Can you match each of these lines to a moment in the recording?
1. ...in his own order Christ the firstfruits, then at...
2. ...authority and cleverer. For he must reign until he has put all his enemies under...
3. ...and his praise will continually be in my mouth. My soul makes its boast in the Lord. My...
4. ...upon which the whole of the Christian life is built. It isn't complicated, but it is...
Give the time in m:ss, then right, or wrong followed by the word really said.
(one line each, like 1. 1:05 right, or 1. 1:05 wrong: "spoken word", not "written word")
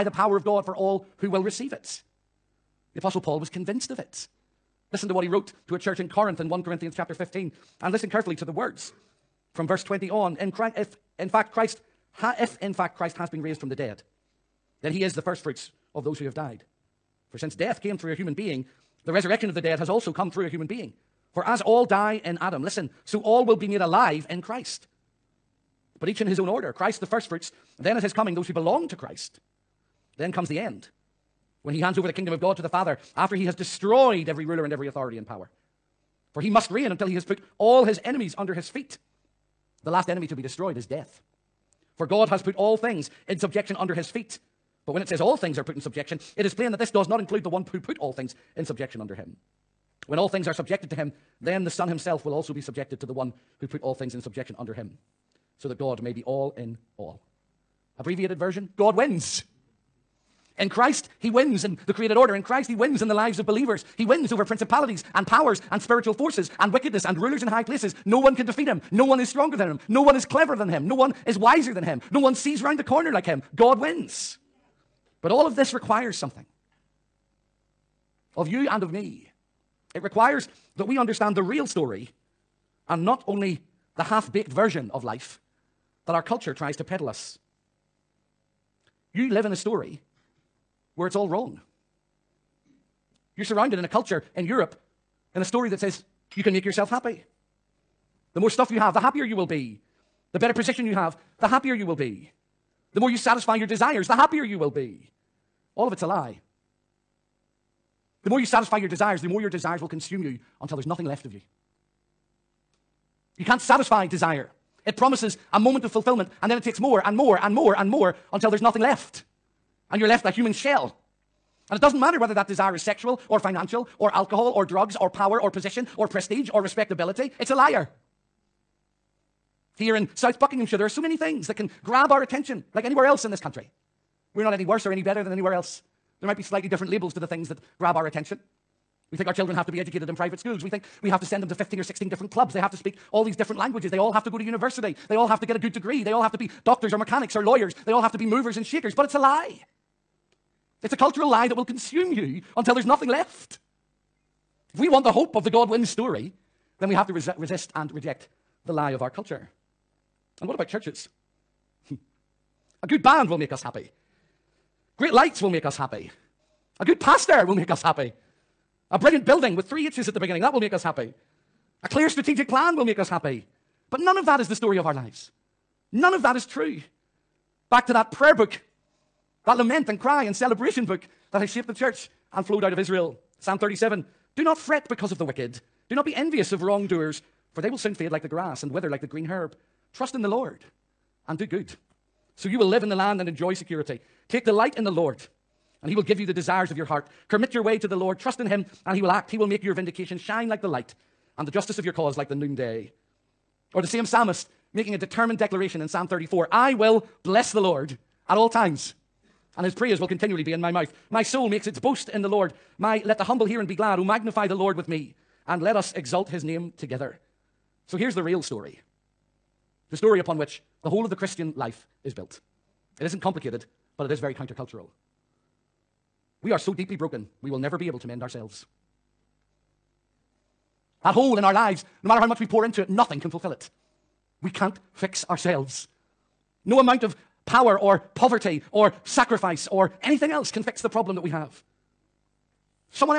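1. 0:26 right
2. 0:34 wrong: "power", not "cleverer"
3. 3:29 right
4. 3:40 right.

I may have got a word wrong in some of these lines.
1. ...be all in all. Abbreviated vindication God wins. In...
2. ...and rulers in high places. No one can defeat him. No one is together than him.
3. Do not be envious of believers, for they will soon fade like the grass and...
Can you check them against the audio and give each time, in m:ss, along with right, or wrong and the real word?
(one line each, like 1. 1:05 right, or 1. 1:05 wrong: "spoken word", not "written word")
1. 0:56 wrong: "version", not "vindication"
2. 1:07 wrong: "stronger", not "together"
3. 3:05 wrong: "wrongdoers", not "believers".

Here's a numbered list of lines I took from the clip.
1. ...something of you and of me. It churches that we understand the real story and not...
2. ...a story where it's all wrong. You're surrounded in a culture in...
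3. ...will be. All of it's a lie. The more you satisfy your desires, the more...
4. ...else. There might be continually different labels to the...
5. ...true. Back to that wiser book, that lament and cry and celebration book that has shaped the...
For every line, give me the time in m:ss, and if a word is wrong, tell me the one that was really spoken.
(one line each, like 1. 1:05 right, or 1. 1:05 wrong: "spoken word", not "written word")
1. 1:16 wrong: "requires", not "churches"
2. 1:29 right
3. 1:44 right
4. 2:15 wrong: "slightly", not "continually"
5. 2:56 wrong: "prayer", not "wiser".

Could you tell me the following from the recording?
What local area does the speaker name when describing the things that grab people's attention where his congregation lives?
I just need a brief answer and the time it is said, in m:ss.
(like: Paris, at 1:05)
South Buckinghamshire, at 2:10.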